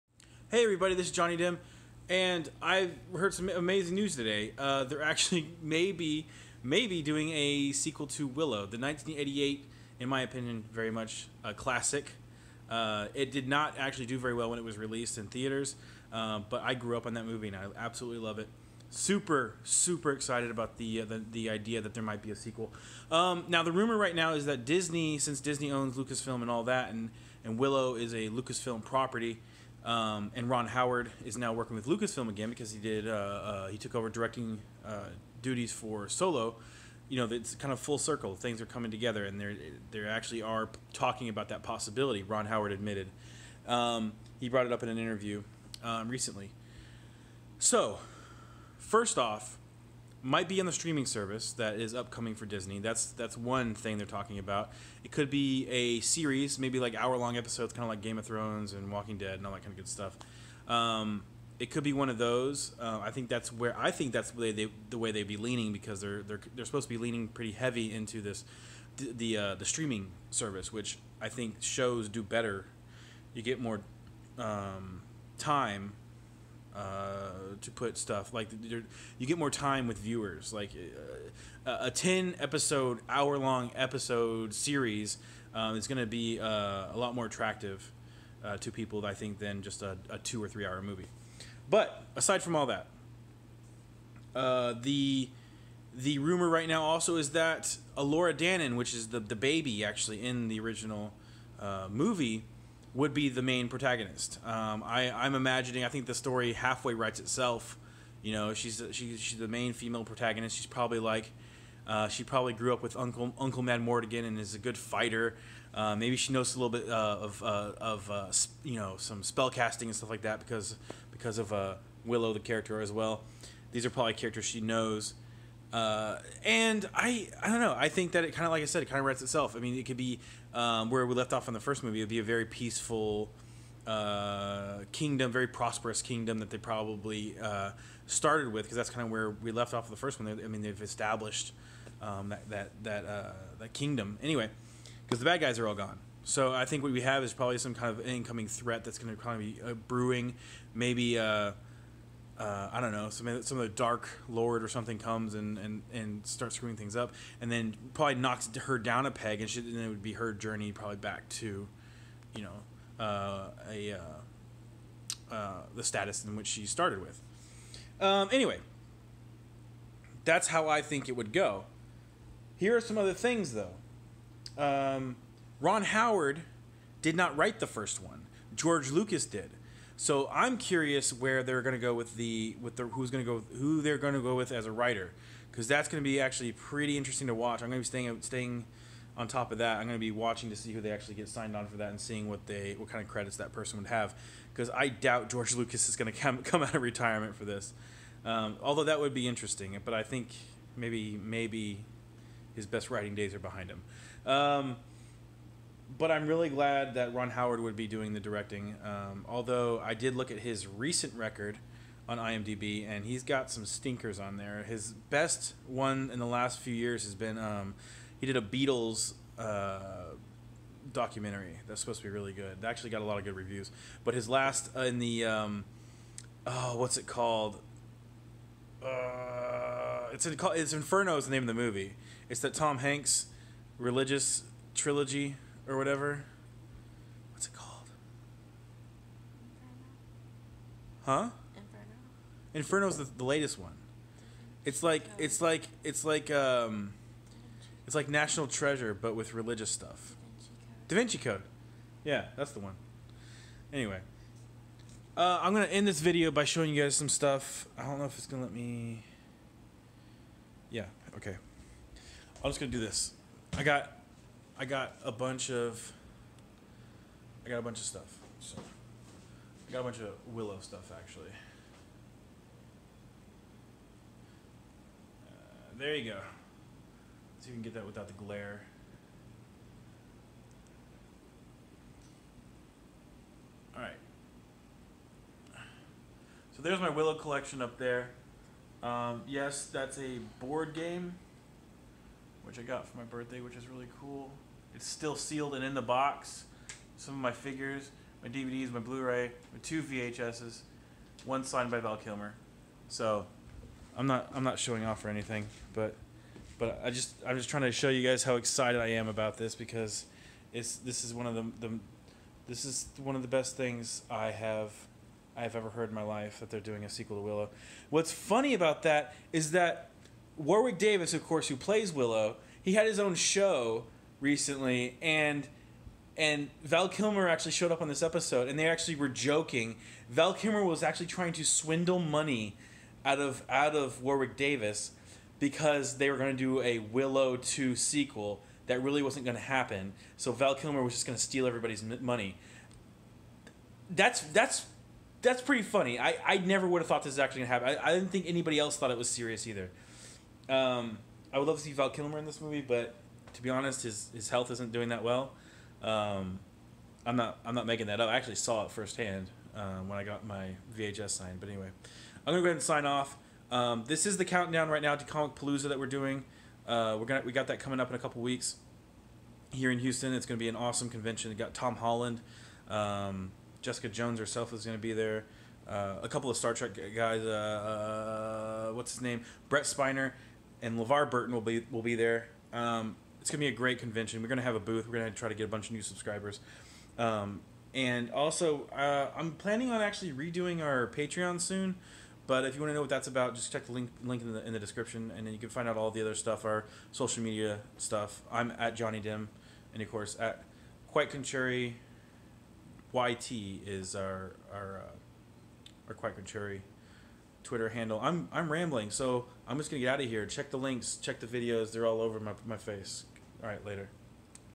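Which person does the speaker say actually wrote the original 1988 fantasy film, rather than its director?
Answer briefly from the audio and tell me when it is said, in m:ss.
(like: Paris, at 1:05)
George Lucas, at 2:58.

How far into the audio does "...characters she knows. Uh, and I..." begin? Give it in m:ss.
2:04.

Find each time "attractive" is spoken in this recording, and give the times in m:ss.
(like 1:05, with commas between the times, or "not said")
1:27.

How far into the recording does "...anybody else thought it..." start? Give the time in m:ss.
5:48.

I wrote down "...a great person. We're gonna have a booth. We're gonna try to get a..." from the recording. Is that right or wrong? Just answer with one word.
wrong.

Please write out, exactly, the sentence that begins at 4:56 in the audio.
Some of my figures, my DVDs, my Blu-ray, my two VHSs, one signed by Val Kilmer.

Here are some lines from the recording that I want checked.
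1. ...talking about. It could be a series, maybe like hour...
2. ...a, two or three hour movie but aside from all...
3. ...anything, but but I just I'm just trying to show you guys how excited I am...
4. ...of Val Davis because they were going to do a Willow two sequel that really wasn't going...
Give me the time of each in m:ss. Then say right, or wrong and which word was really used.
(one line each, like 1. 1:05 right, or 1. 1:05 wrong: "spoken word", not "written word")
1. 0:54 right
2. 1:30 right
3. 5:05 right
4. 5:33 wrong: "Warwick", not "Val".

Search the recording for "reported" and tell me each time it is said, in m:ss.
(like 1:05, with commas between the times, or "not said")
not said.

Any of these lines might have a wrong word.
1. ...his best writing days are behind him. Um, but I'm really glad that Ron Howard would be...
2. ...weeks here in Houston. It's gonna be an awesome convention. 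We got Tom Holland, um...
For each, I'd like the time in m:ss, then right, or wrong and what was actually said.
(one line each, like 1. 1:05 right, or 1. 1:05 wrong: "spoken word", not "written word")
1. 3:22 right
2. 6:08 right.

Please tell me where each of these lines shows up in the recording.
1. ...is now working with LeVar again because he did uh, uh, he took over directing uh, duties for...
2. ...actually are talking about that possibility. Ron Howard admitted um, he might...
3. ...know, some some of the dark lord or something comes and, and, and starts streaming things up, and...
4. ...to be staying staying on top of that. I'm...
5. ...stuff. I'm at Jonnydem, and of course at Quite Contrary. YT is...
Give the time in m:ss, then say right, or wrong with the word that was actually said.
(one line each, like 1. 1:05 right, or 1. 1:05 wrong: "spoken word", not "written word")
1. 0:31 wrong: "Lucasfilm", not "LeVar"
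2. 0:40 wrong: "brought", not "might"
3. 2:32 wrong: "screwing", not "streaming"
4. 3:07 right
5. 6:37 right.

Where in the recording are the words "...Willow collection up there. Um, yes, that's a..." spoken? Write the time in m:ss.
4:46.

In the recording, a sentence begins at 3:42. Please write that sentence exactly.
That actually got a lot of good reviews.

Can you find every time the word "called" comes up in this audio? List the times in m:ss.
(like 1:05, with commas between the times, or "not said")
3:47, 3:57.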